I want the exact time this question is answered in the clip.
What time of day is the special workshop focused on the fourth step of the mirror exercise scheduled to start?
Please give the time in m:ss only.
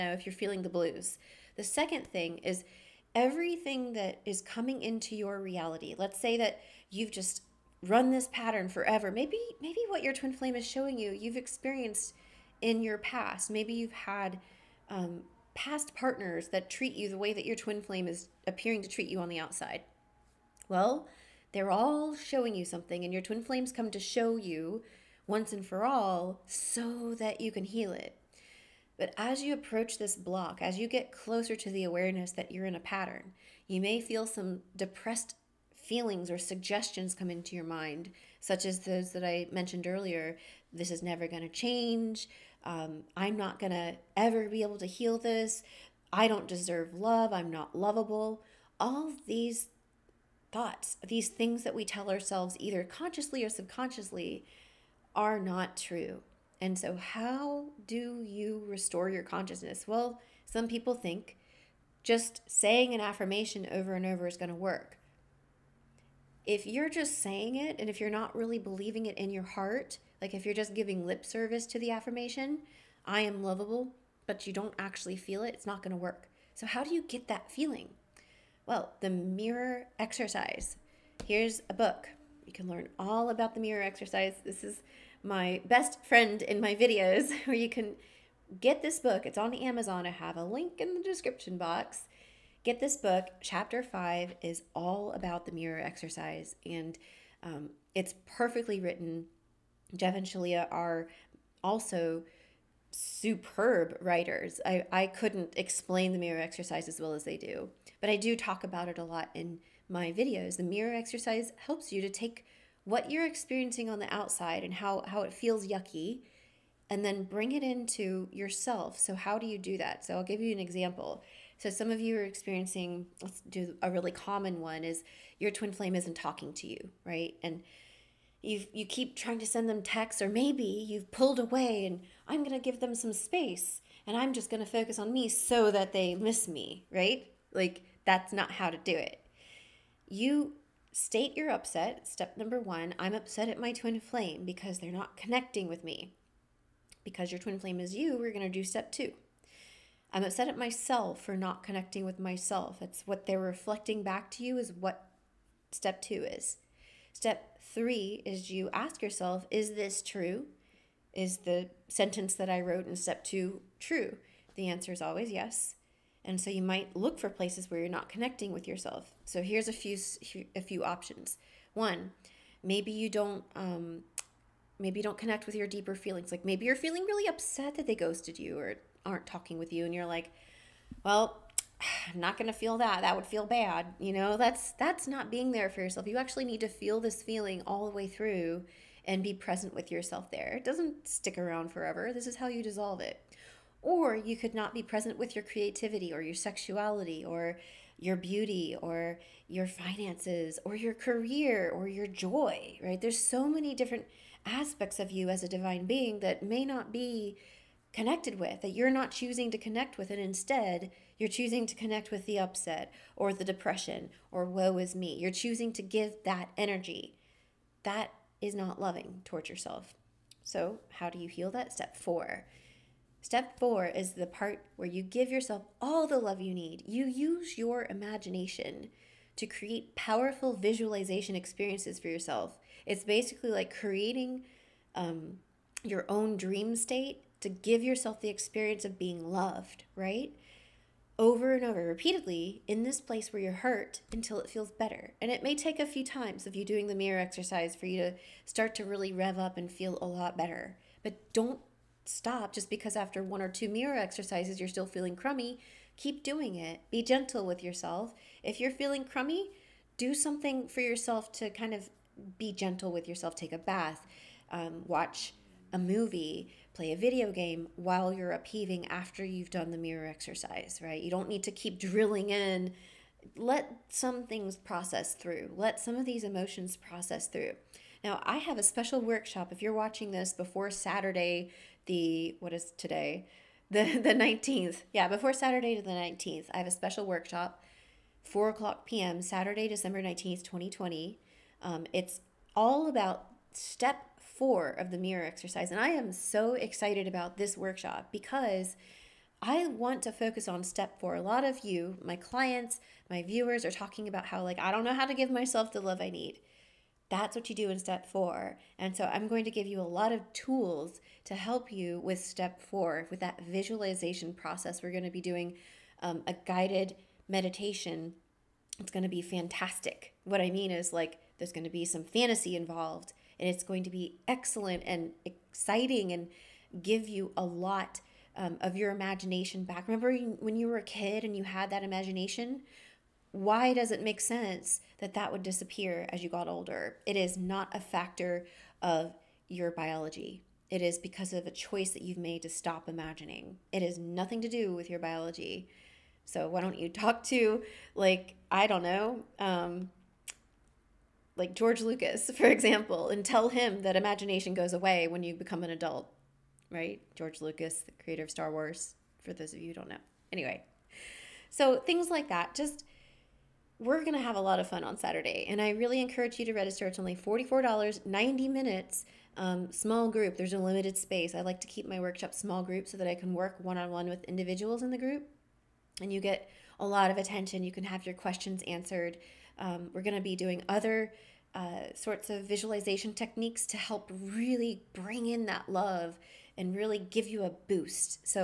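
4:48.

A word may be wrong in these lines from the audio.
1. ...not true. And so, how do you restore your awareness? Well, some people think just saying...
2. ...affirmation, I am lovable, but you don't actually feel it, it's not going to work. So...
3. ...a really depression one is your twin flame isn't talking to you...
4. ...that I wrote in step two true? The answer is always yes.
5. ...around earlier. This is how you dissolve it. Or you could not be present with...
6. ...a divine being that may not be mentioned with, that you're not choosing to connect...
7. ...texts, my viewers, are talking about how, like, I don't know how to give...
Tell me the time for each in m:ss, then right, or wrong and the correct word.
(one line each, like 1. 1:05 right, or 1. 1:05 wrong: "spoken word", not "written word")
1. 0:55 wrong: "consciousness", not "awareness"
2. 1:11 right
3. 2:03 wrong: "common", not "depression"
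4. 2:42 right
5. 3:11 wrong: "forever", not "earlier"
6. 3:25 wrong: "connected", not "mentioned"
7. 5:02 wrong: "clients", not "texts".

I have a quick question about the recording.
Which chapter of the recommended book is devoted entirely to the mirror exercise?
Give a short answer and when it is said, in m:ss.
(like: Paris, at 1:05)
Chapter 5, at 1:33.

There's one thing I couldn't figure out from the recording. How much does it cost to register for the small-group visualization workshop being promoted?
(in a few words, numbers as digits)
$44.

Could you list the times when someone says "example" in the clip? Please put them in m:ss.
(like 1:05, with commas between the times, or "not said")
2:00, 5:52.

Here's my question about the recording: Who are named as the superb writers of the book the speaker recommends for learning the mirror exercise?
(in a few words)
Jeff and Shaleia.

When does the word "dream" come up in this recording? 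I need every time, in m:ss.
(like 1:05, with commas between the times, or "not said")
3:56.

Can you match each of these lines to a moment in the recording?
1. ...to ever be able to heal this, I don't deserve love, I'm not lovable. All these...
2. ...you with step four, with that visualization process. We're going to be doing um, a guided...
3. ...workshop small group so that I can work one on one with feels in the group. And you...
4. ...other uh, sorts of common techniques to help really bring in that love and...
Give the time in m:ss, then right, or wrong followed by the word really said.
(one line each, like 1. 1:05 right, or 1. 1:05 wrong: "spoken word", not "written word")
1. 0:43 right
2. 5:11 right
3. 6:11 wrong: "individuals", not "feels"
4. 6:20 wrong: "visualization", not "common".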